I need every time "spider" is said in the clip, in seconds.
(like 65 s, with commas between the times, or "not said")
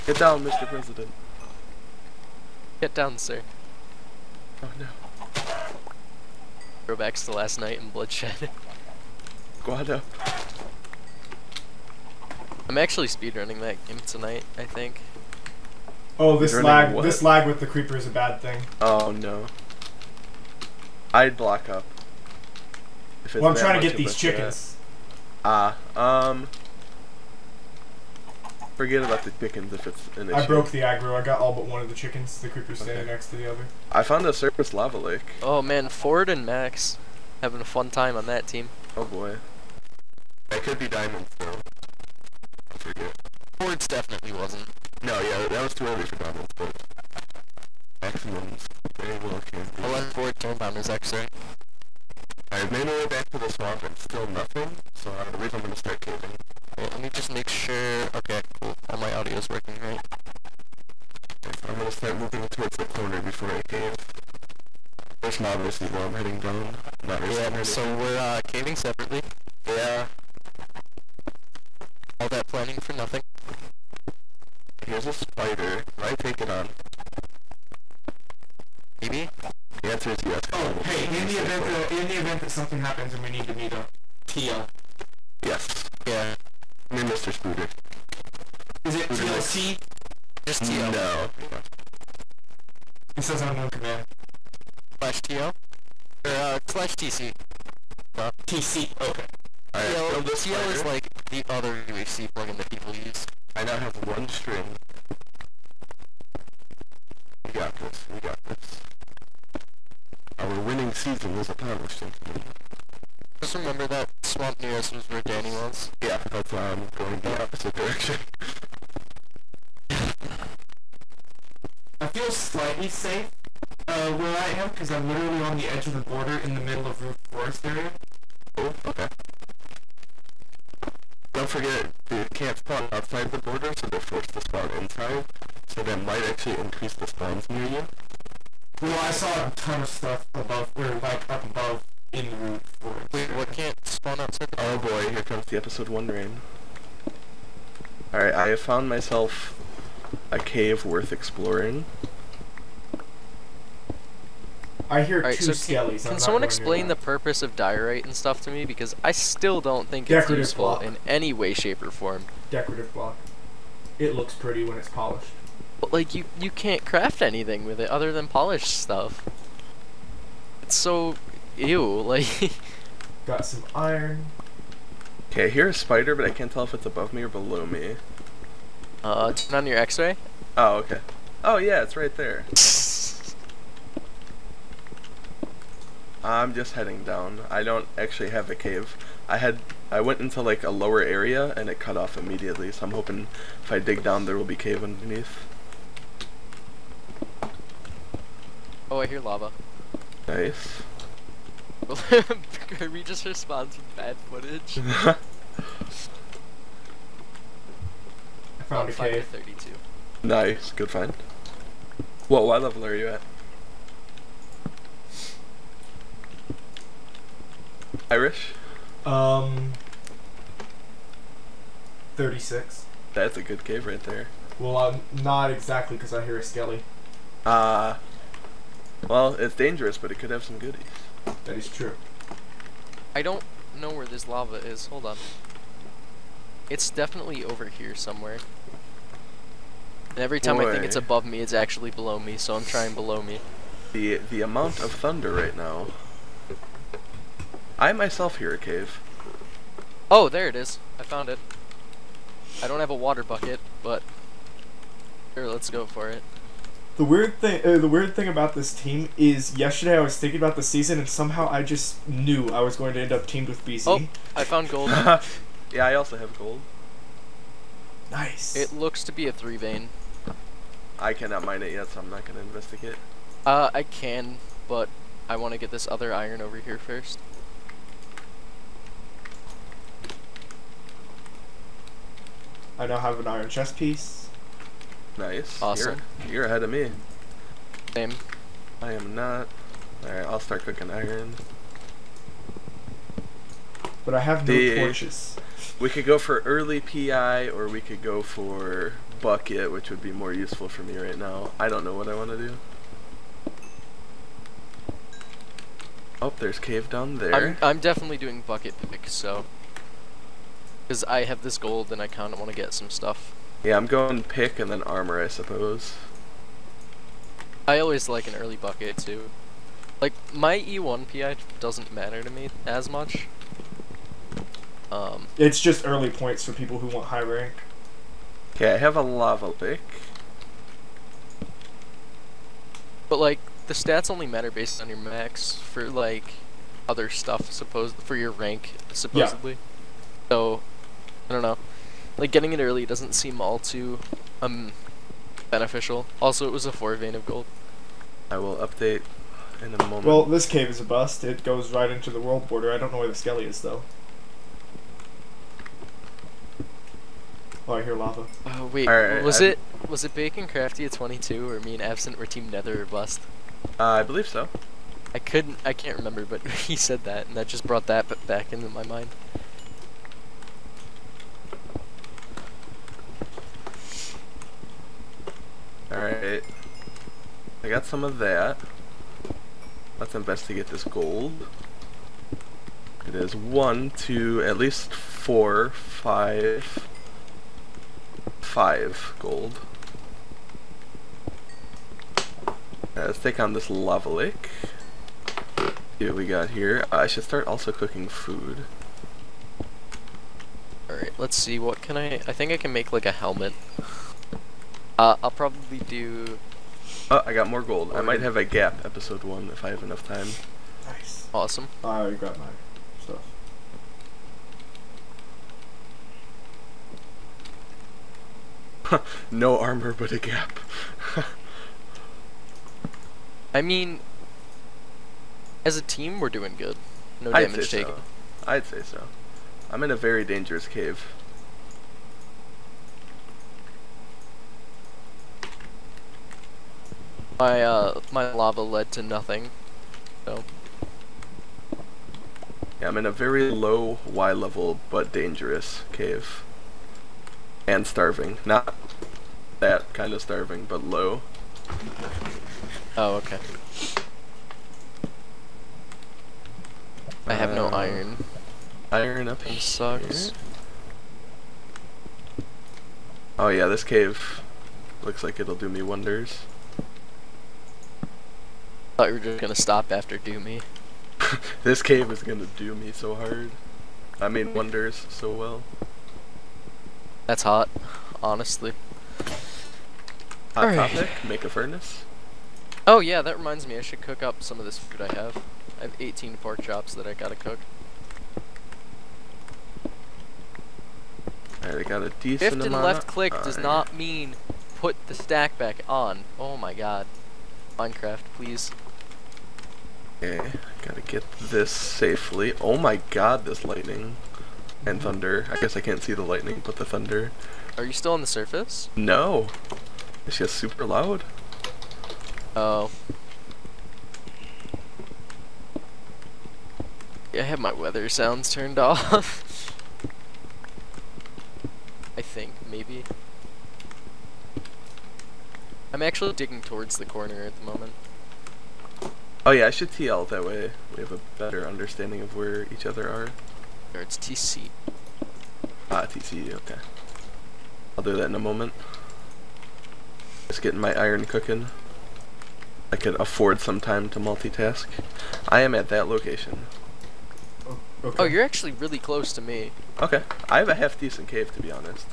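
75 s, 100 s, 175 s.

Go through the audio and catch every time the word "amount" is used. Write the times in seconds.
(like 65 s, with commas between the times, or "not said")
244 s.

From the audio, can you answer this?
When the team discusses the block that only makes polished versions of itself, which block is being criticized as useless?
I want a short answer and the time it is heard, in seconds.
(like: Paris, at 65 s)
diorite, at 157 s.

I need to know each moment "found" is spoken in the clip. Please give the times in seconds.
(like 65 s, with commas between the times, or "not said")
34 s, 148 s, 208 s, 251 s, 264 s.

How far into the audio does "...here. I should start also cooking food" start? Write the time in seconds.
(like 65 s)
396 s.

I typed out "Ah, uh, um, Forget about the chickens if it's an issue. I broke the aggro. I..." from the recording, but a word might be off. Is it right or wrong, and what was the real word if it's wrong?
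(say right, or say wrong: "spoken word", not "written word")
right.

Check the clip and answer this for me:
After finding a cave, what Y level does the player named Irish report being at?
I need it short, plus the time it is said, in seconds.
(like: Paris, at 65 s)
36, at 222 s.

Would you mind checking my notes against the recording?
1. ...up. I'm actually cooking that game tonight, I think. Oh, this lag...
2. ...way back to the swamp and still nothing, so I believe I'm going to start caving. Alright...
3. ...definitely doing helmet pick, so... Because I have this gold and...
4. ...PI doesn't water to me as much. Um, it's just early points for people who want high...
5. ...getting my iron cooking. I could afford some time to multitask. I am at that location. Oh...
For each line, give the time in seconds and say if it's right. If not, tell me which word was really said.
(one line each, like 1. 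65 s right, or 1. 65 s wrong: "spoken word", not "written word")
1. 9 s wrong: "speedrunning", not "cooking"
2. 52 s right
3. 307 s wrong: "bucket", not "helmet"
4. 321 s wrong: "matter", not "water"
5. 540 s right.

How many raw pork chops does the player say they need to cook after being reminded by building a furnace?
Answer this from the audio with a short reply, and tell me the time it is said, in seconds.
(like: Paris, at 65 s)
18, at 485 s.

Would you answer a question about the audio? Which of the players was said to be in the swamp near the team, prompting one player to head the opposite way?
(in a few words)
Danny.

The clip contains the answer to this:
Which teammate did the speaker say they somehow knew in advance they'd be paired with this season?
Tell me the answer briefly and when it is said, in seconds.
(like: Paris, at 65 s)
BZ, at 263 s.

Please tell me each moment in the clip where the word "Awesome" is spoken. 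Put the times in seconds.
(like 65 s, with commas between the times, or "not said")
285 s, 411 s.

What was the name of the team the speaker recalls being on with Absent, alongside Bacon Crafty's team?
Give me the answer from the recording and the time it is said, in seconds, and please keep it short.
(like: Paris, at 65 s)
Team Nether or Bust, at 362 s.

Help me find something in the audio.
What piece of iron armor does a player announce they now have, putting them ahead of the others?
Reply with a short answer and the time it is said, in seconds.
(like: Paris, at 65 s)
iron chest piece, at 283 s.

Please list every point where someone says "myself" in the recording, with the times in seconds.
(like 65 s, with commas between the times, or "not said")
148 s, 247 s.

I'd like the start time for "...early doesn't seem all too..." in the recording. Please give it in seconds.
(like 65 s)
342 s.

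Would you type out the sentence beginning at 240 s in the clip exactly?
I think it's above me, it's actually below me, so I'm trying below me.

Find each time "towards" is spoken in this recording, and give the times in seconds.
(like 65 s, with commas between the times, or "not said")
62 s, 526 s.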